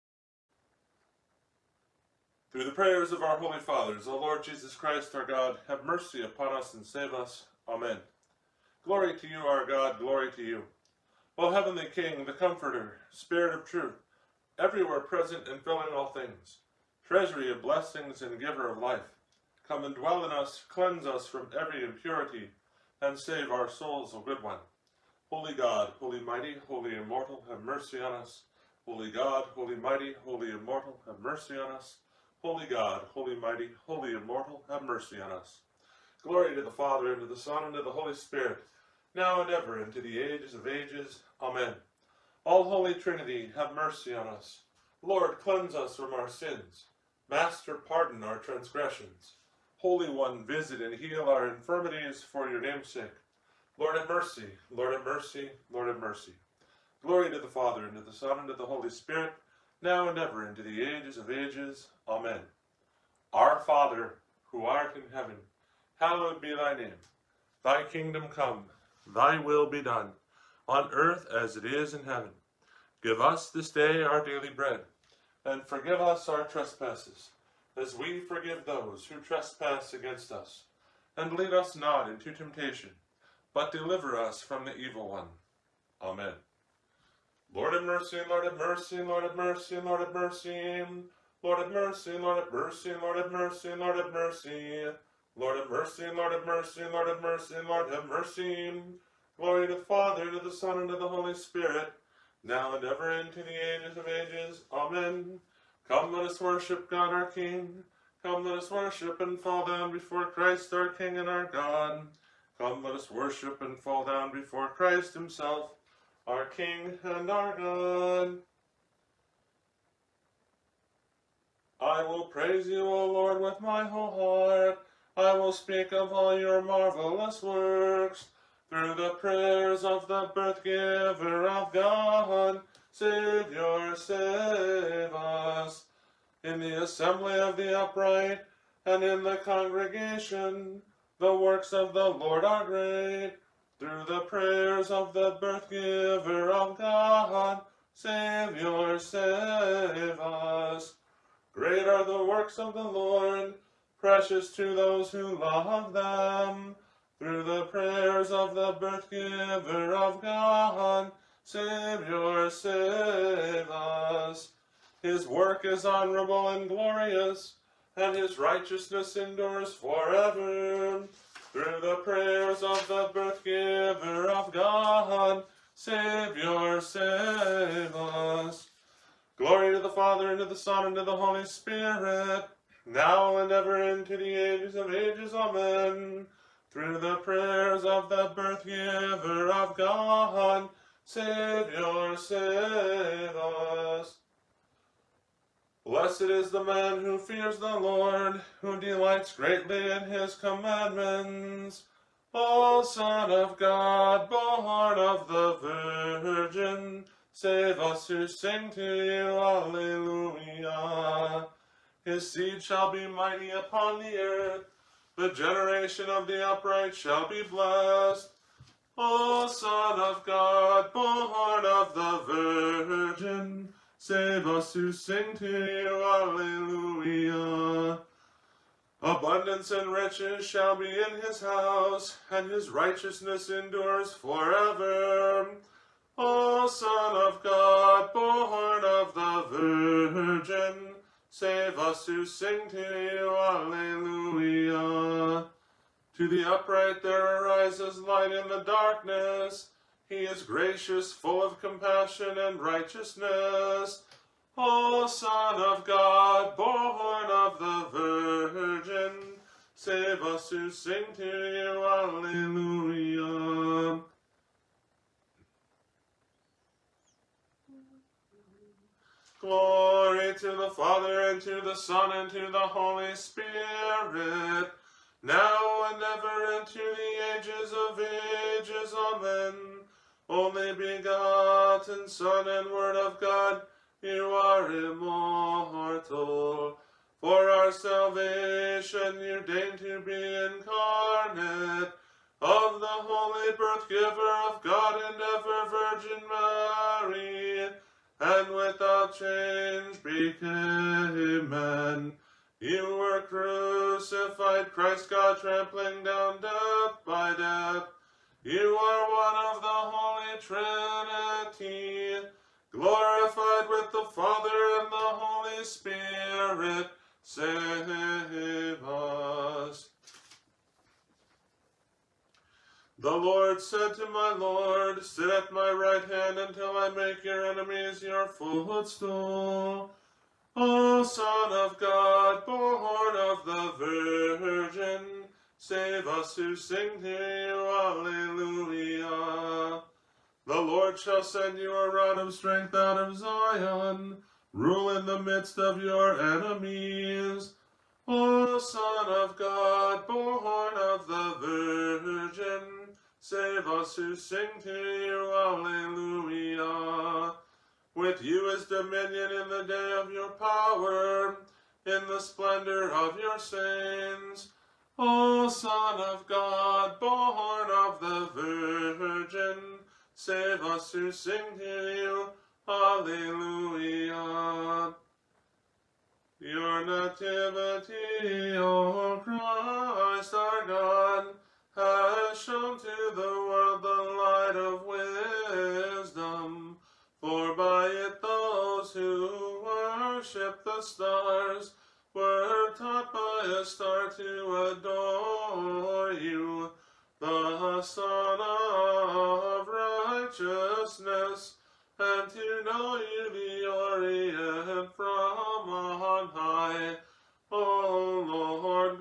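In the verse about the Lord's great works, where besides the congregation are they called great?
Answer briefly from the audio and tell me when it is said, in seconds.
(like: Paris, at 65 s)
the assembly of the upright, at 136 s.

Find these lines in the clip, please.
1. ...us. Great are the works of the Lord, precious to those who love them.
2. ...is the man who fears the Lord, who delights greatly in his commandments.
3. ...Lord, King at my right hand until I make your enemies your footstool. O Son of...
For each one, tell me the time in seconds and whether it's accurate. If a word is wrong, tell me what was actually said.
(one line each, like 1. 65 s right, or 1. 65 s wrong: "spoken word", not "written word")
1. 150 s right
2. 196 s right
3. 324 s wrong: "Sit", not "King".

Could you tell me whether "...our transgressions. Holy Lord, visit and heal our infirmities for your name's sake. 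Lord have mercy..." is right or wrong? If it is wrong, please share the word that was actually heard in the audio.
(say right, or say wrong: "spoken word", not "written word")
wrong: "One", not "Lord".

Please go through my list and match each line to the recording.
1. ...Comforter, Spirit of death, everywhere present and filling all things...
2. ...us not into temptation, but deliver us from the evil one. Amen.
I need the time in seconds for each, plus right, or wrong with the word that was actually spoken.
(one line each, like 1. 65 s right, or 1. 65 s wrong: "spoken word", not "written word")
1. 12 s wrong: "truth", not "death"
2. 81 s right.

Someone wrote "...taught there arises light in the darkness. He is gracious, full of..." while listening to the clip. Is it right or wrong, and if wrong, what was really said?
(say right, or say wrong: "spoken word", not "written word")
wrong: "upright", not "taught".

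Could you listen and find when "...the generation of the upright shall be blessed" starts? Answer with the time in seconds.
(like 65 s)
215 s.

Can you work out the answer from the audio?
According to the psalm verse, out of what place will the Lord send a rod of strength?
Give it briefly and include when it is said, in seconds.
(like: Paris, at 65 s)
Zion, at 343 s.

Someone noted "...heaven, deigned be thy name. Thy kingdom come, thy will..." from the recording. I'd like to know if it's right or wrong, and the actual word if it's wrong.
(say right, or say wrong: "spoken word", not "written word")
wrong: "hallowed", not "deigned".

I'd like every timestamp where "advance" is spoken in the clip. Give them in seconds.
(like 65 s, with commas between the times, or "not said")
not said.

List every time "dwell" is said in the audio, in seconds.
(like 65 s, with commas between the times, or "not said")
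19 s.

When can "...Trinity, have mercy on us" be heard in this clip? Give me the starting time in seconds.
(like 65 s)
42 s.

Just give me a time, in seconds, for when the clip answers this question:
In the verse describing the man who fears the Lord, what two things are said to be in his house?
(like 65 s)
229 s.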